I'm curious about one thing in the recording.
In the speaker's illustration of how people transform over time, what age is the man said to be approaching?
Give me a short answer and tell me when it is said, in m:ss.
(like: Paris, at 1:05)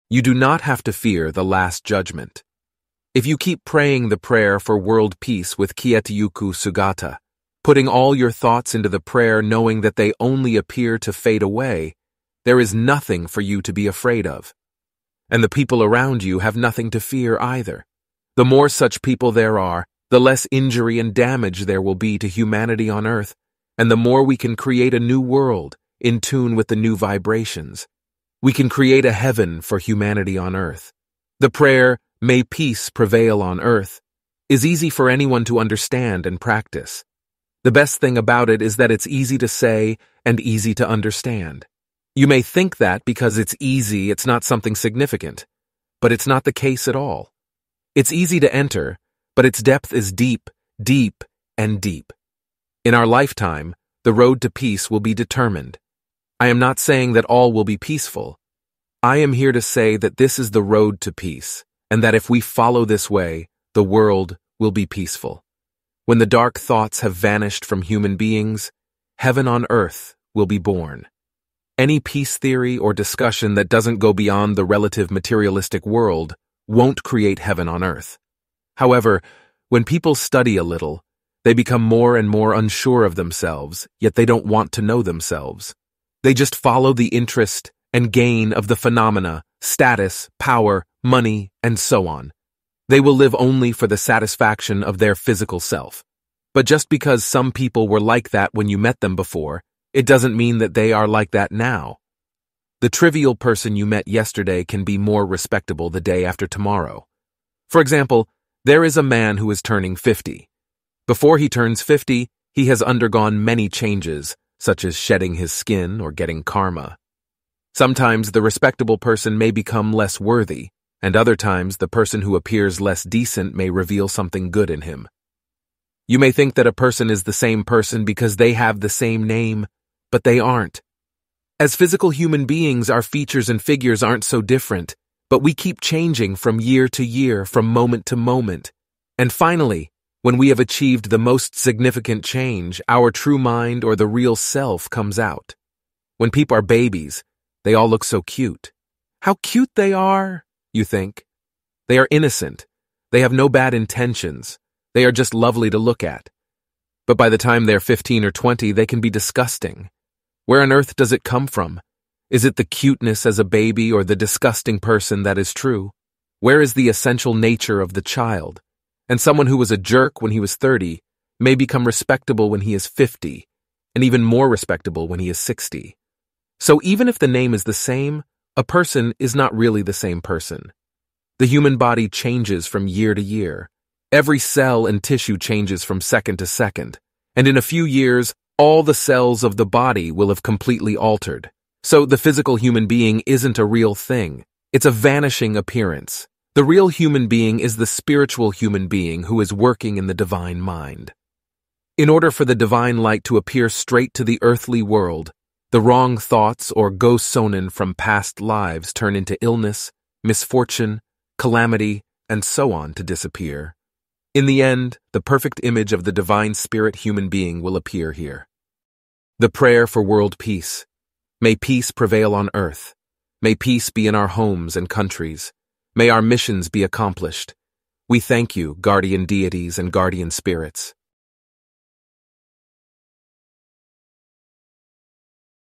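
50, at 1:49.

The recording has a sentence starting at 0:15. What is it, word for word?
And the people around you have nothing to fear either.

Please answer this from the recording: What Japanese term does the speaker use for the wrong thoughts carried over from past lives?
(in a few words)
go sonin.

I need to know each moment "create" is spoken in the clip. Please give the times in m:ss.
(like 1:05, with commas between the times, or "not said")
0:24, 0:28, 1:17.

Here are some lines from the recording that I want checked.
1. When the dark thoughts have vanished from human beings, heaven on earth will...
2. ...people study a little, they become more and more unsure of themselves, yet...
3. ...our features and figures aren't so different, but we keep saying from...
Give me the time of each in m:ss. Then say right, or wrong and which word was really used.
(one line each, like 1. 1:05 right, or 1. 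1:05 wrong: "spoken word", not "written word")
1. 1:06 right
2. 1:19 right
3. 2:12 wrong: "changing", not "saying".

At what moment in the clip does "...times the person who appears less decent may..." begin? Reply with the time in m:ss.
2:01.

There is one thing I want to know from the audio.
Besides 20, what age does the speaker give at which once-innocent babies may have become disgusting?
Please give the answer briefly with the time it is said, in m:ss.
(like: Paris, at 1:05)
15, at 2:37.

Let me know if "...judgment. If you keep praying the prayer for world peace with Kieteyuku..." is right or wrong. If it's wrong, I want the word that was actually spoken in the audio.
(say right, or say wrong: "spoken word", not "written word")
right.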